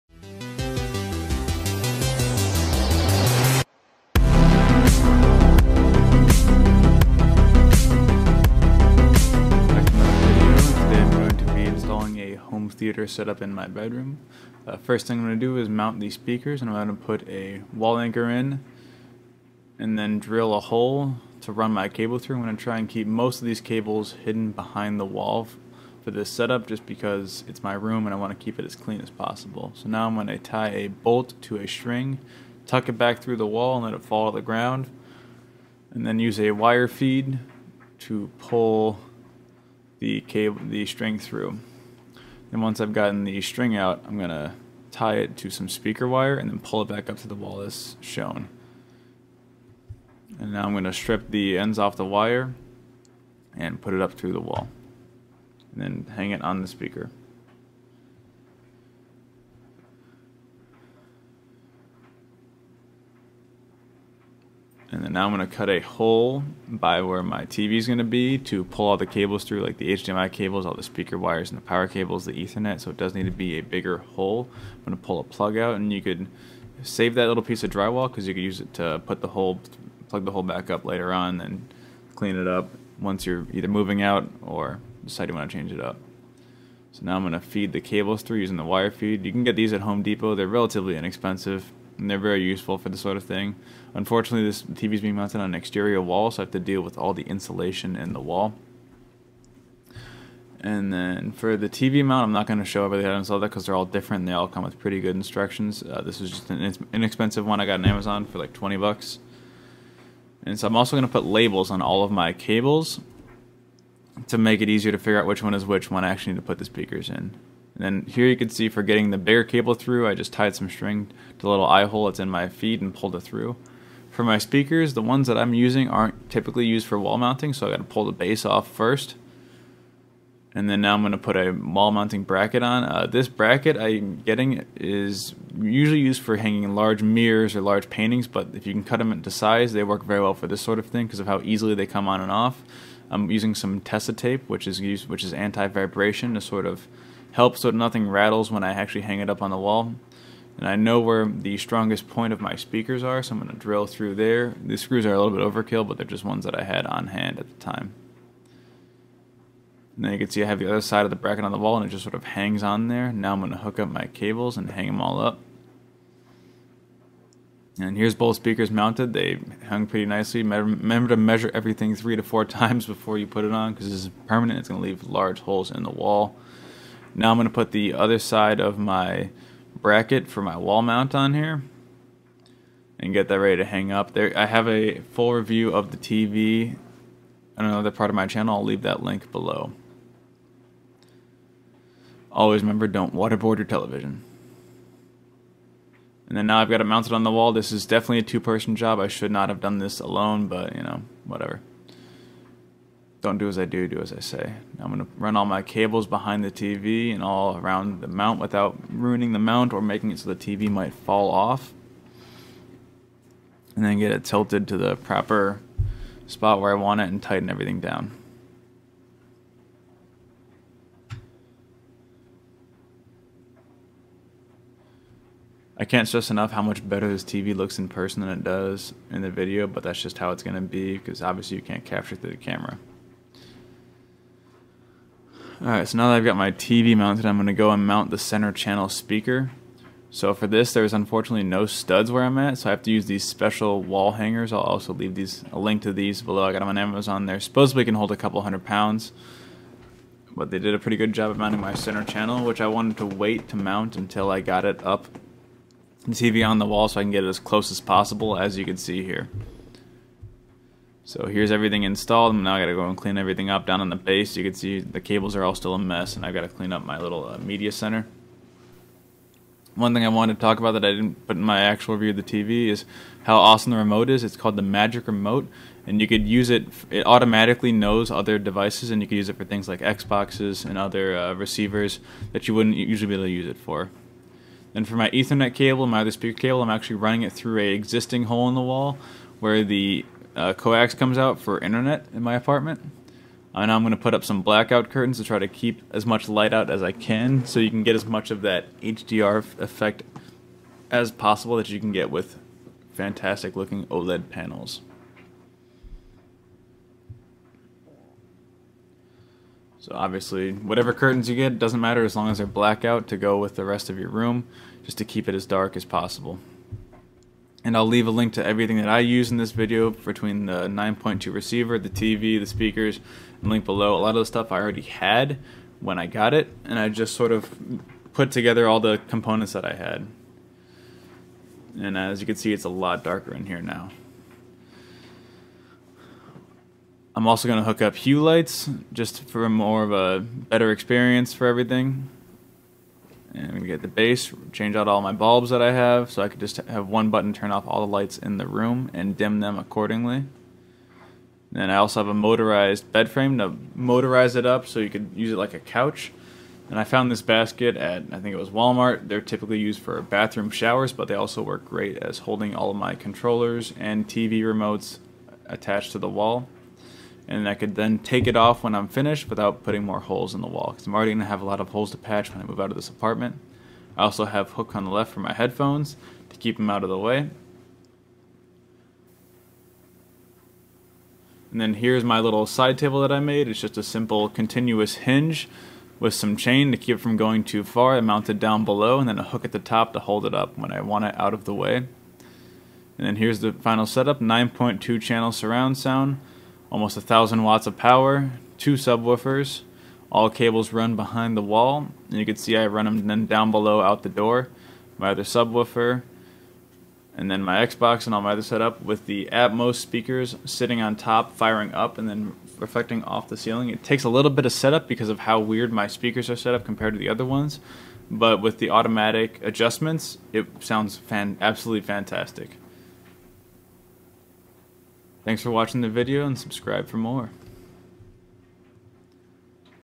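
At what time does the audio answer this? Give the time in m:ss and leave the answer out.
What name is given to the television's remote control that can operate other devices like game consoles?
4:34.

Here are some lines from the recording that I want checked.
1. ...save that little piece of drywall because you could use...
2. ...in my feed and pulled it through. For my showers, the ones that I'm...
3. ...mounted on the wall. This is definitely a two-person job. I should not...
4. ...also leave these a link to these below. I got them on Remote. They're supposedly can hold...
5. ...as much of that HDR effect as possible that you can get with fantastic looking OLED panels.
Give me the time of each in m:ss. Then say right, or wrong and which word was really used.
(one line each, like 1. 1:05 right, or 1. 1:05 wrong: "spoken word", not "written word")
1. 1:16 right
2. 2:02 wrong: "speakers", not "showers"
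3. 3:16 right
4. 4:04 wrong: "Amazon", not "Remote"
5. 4:57 right.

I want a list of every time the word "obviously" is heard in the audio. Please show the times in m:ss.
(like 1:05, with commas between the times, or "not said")
3:51, 5:09.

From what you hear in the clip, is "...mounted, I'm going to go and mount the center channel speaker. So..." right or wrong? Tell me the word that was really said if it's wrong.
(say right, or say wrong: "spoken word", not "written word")
right.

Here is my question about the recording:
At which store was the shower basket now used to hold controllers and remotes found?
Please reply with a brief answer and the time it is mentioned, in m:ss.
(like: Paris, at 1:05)
Walmart, at 5:58.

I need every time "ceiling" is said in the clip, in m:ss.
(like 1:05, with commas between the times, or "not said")
6:53.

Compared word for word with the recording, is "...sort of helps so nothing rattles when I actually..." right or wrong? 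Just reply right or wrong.
right.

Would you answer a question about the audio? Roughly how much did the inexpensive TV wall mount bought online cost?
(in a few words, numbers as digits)
$20.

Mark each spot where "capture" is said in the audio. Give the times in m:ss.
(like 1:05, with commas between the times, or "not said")
3:51.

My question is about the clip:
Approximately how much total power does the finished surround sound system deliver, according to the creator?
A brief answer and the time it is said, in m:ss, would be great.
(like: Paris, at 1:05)
Almost 1000 watts, at 6:36.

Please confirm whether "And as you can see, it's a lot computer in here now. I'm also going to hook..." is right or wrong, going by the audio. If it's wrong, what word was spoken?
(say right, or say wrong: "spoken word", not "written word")
wrong: "darker", not "computer".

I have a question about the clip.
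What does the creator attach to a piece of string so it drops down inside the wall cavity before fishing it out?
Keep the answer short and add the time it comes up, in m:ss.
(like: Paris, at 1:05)
A bolt, at 0:30.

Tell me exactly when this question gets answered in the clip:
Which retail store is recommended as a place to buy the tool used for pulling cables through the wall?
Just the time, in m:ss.
1:29.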